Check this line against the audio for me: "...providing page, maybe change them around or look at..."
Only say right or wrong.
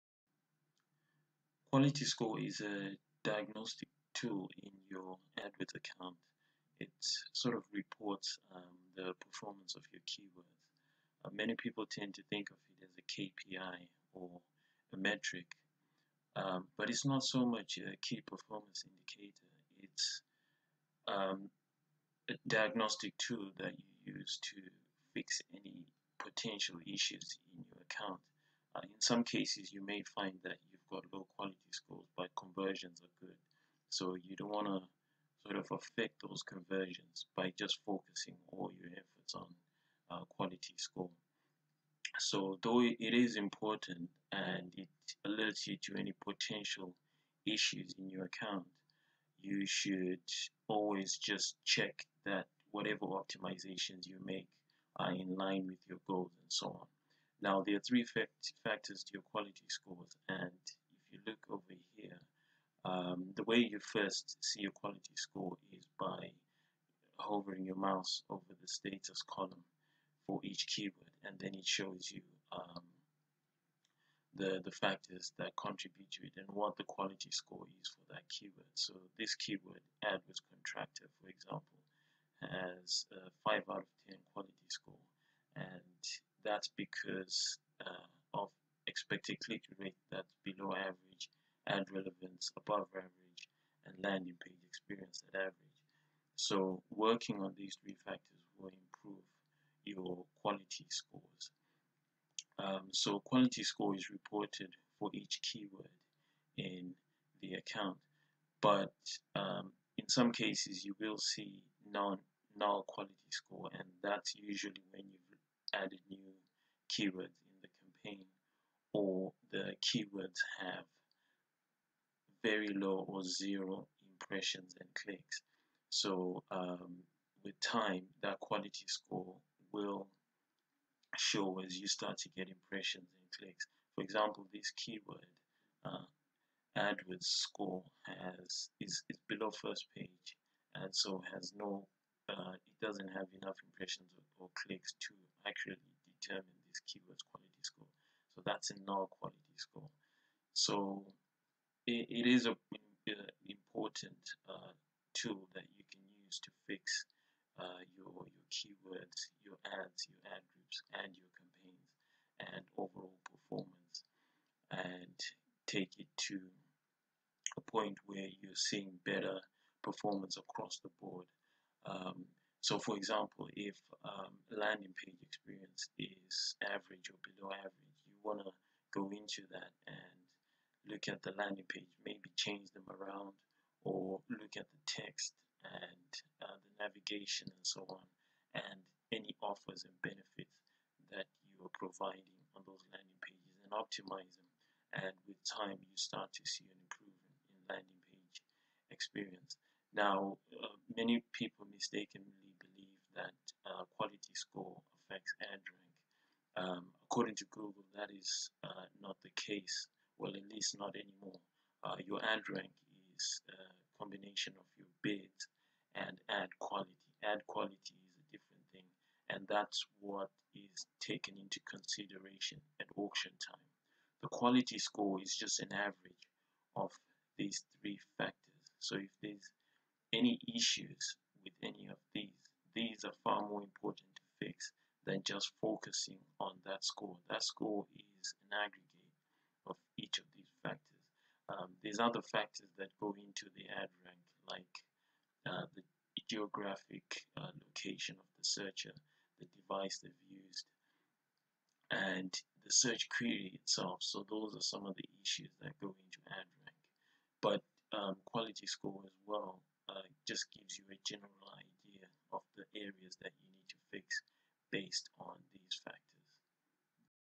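wrong.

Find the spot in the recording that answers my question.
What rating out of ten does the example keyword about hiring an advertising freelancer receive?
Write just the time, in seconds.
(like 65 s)
83 s.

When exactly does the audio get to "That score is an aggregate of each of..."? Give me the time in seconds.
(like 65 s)
237 s.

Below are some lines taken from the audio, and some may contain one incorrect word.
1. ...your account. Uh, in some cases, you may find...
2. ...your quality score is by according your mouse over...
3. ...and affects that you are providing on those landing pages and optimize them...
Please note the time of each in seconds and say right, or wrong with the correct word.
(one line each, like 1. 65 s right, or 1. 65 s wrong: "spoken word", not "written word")
1. 27 s right
2. 64 s wrong: "hovering", not "according"
3. 189 s wrong: "benefits", not "affects".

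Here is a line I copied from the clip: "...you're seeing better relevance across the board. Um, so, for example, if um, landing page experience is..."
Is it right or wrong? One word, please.
wrong.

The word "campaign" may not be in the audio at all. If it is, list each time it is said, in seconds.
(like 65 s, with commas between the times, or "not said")
117 s, 161 s.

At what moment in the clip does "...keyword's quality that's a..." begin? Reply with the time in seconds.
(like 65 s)
146 s.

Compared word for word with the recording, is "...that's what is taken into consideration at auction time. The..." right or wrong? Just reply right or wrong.
right.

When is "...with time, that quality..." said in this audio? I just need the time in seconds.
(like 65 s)
127 s.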